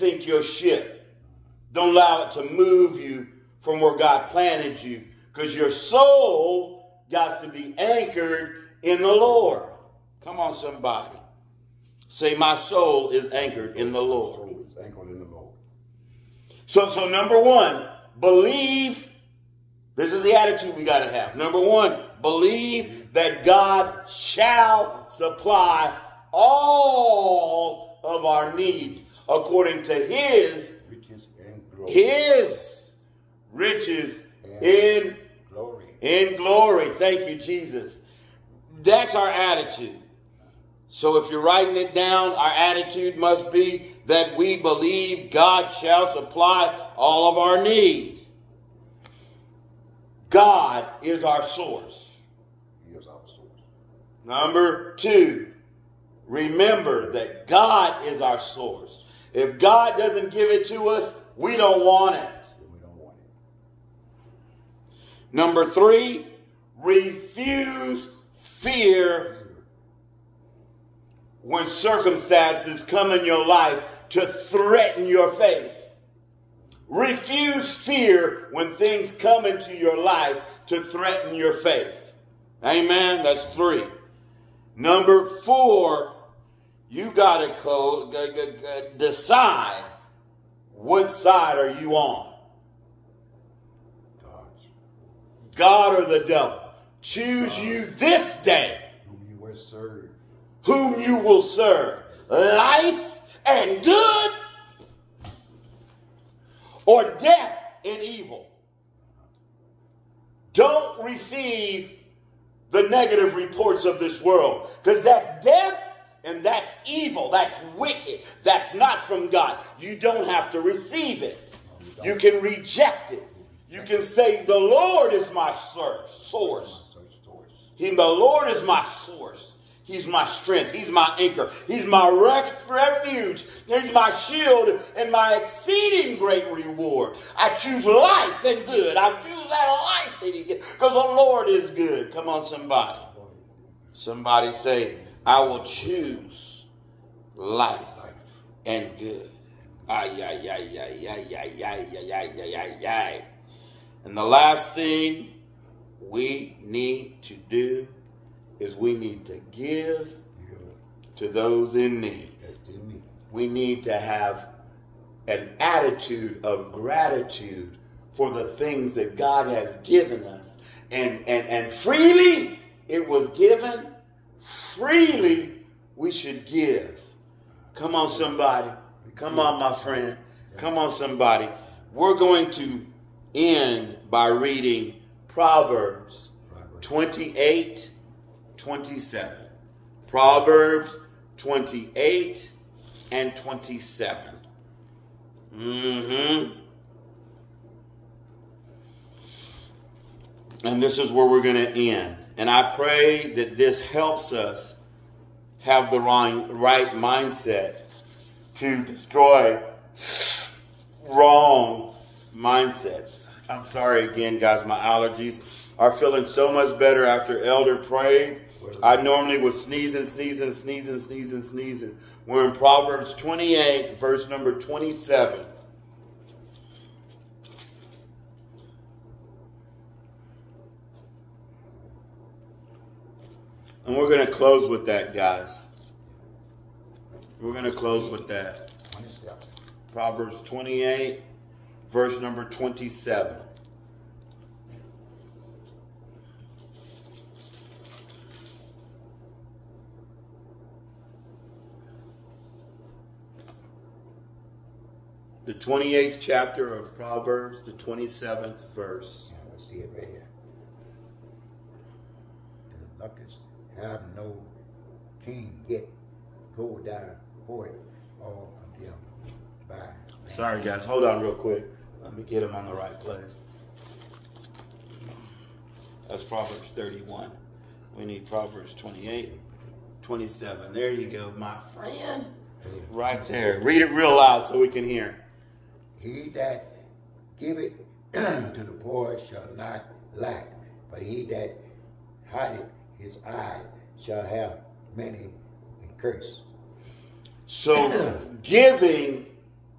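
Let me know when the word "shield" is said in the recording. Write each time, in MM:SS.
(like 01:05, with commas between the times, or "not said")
02:14.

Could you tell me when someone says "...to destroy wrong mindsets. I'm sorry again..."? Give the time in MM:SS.
03:28.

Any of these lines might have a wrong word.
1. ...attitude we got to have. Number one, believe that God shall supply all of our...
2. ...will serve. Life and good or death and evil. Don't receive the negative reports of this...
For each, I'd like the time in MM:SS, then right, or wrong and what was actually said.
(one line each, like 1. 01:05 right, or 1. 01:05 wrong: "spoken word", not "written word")
1. 00:20 right
2. 01:41 right.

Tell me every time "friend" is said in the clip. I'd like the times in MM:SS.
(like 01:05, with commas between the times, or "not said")
02:59, 04:41.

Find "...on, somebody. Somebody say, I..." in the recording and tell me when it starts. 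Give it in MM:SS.
02:22.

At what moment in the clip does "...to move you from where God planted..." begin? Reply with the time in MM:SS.
00:02.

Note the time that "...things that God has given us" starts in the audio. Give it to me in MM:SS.
02:48.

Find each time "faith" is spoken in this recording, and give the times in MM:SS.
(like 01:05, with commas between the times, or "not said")
01:15, 01:21.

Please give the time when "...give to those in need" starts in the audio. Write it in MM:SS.
02:39.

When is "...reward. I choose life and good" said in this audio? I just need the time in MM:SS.
02:16.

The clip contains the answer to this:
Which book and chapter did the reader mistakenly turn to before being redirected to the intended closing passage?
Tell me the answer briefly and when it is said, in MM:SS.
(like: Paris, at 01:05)
Proverbs 31, at 04:36.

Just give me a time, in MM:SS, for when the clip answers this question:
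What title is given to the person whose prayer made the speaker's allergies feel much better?
03:37.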